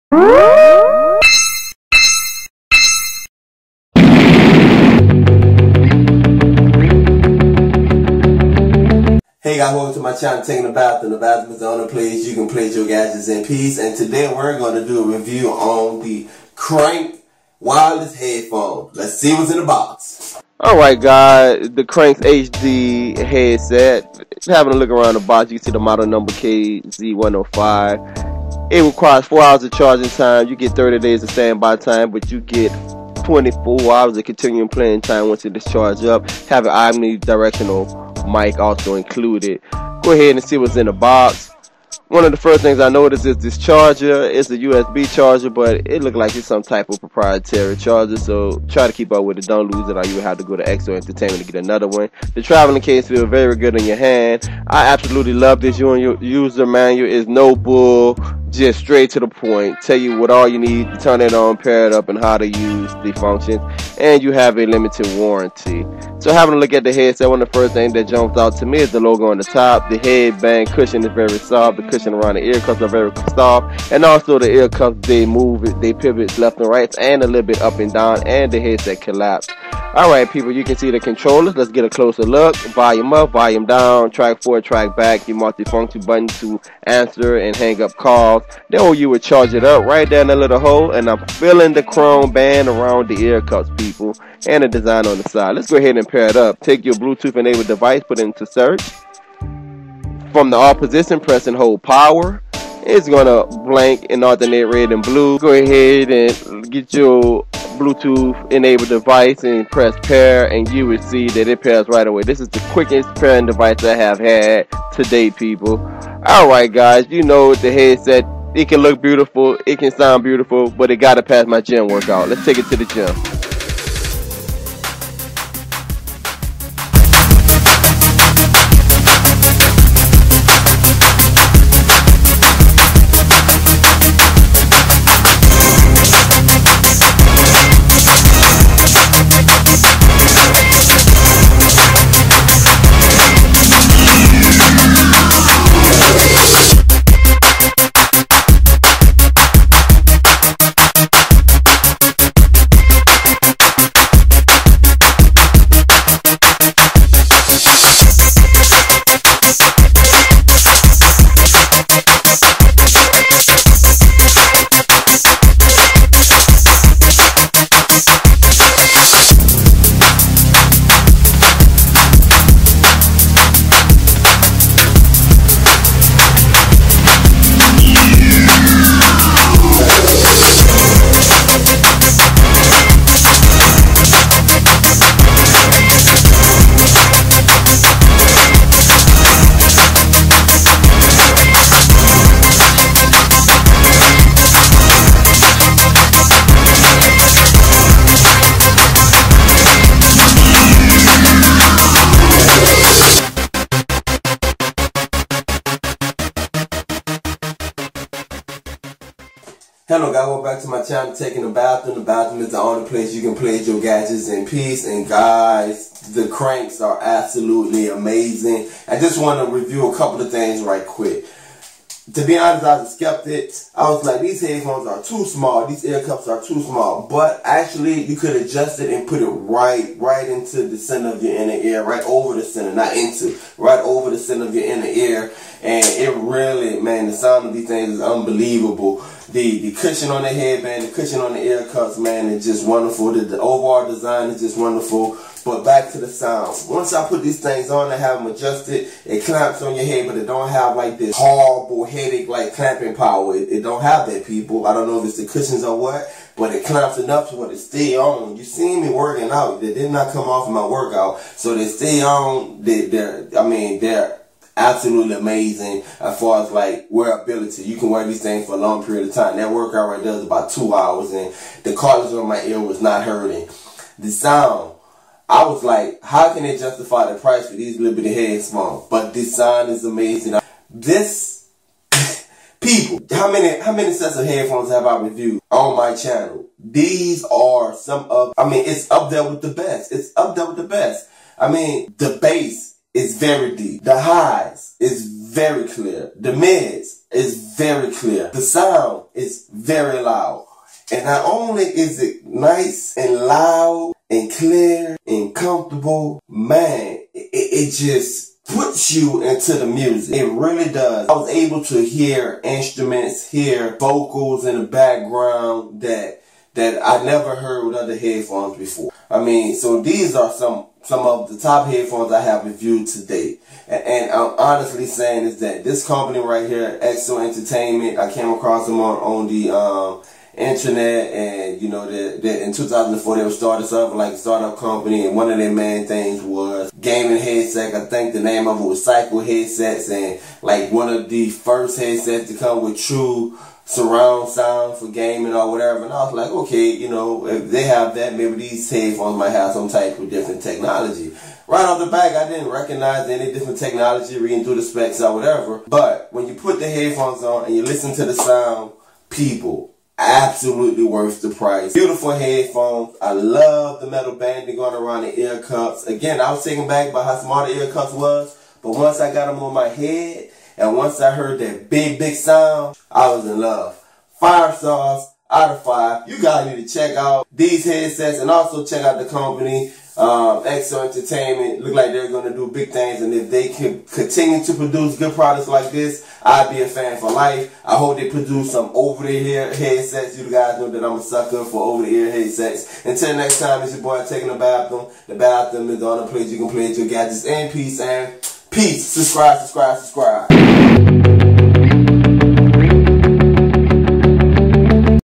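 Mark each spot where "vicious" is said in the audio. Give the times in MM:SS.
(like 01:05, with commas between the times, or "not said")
not said.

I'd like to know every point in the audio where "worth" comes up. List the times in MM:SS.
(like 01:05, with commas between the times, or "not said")
06:00.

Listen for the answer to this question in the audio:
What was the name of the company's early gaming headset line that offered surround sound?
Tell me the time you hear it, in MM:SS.
05:38.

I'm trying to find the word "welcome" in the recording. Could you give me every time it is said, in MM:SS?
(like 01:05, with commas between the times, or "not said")
00:09, 03:30.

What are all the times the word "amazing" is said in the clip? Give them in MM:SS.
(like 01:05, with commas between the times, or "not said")
03:37, 04:25, 04:39.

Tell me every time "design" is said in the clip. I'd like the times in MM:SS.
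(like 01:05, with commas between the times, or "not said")
01:34, 04:03.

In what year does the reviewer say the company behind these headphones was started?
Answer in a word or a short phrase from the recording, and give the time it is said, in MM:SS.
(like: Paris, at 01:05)
2004, at 05:32.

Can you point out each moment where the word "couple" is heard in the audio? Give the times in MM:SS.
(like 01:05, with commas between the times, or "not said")
03:39.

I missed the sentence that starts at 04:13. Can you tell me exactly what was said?
It, it don't have that, people.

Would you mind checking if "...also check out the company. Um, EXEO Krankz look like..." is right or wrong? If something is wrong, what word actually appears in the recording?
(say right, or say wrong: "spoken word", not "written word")
wrong: "Entertainment", not "Krankz".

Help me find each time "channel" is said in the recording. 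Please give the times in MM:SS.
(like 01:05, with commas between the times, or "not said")
00:10, 03:30, 04:45.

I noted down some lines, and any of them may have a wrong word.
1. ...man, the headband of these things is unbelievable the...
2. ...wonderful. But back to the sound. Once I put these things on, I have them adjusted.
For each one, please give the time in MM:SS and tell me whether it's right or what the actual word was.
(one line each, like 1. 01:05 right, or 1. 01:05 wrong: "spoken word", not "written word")
1. 03:56 wrong: "sound", not "headband"
2. 04:04 right.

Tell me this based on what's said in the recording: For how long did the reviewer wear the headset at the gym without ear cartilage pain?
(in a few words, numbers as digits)
about two hours.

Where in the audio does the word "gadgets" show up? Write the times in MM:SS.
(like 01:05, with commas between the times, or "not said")
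00:12, 03:33, 06:36.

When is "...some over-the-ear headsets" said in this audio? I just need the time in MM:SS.
06:28.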